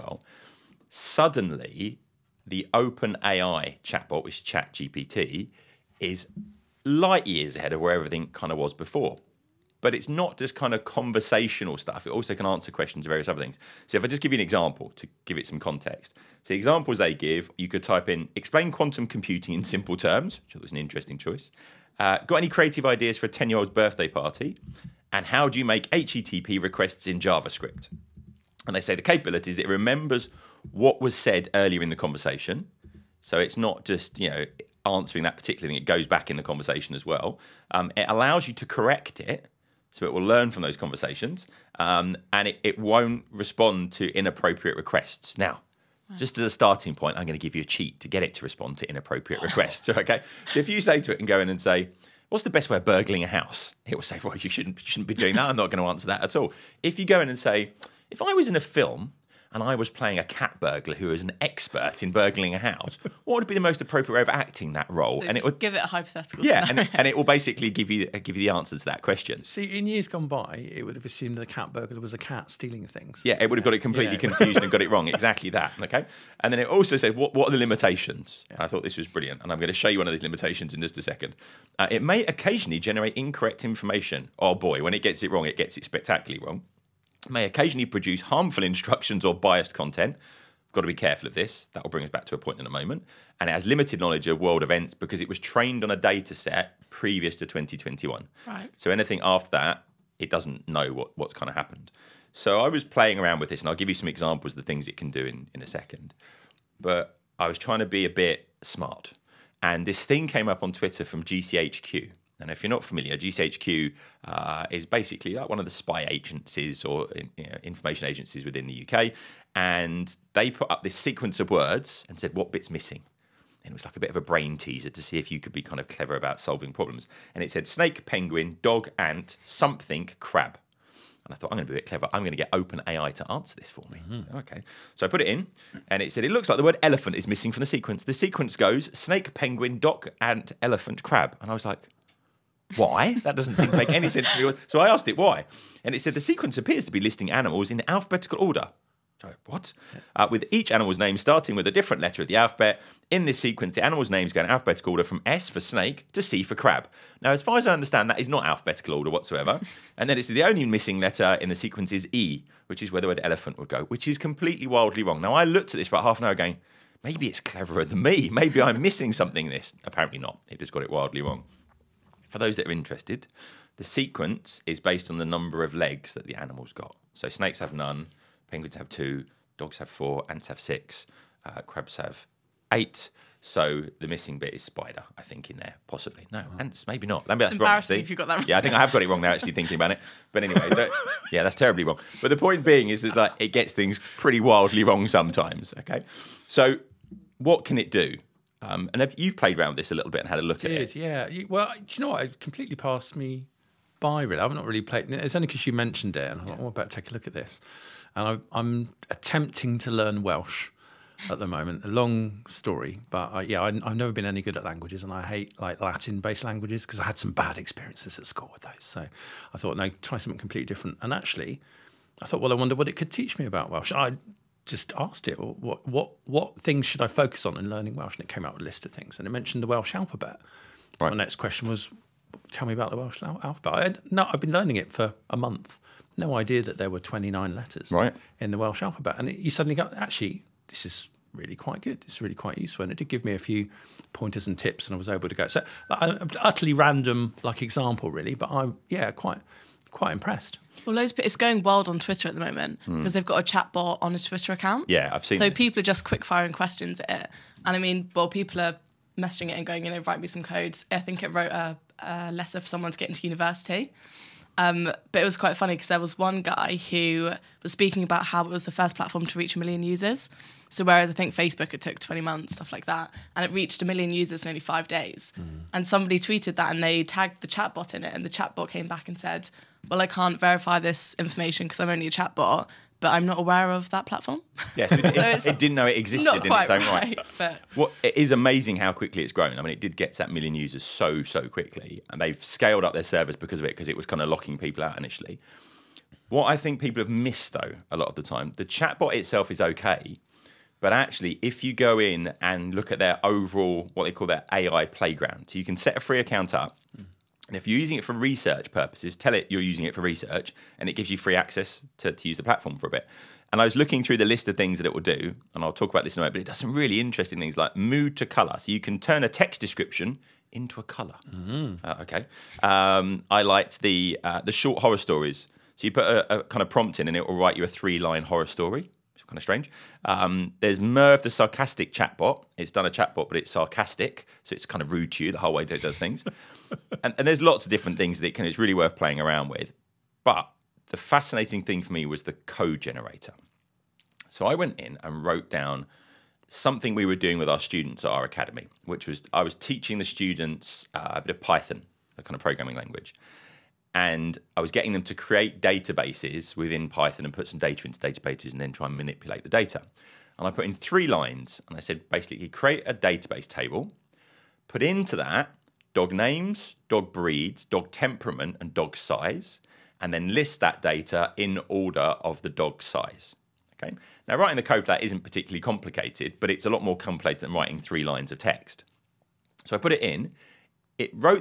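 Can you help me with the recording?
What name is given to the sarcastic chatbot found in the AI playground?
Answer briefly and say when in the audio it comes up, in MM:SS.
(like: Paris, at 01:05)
Merv, at 05:30.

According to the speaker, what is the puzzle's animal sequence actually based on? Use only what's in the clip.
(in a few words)
Number of legs.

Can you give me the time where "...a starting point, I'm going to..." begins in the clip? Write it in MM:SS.
00:46.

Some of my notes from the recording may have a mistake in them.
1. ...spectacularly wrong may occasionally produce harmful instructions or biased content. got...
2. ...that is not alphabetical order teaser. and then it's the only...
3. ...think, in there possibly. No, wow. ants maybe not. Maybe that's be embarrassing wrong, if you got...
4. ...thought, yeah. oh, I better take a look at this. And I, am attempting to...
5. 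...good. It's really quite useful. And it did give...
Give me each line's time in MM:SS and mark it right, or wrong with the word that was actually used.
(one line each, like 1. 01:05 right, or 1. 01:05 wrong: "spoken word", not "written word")
1. 01:25 right
2. 02:38 wrong: "whatsoever", not "teaser"
3. 03:05 right
4. 03:26 right
5. 04:01 right.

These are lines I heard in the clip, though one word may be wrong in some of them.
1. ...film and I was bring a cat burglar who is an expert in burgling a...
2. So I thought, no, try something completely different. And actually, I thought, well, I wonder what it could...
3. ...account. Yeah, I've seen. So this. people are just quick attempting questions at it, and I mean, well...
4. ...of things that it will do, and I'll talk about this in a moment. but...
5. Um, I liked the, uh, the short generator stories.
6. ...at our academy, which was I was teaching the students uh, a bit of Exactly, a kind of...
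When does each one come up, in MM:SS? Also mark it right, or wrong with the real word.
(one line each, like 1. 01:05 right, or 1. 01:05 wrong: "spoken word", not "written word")
1. 00:58 wrong: "playing", not "bring"
2. 03:38 right
3. 04:14 wrong: "firing", not "attempting"
4. 05:14 right
5. 05:22 wrong: "horror", not "generator"
6. 05:48 wrong: "Python", not "Exactly".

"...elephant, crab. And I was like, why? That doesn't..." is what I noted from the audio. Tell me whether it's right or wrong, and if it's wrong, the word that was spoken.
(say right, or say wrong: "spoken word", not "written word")
right.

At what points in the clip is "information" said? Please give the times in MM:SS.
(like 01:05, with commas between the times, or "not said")
01:23, 01:57, 04:41.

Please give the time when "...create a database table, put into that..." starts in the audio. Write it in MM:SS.
06:02.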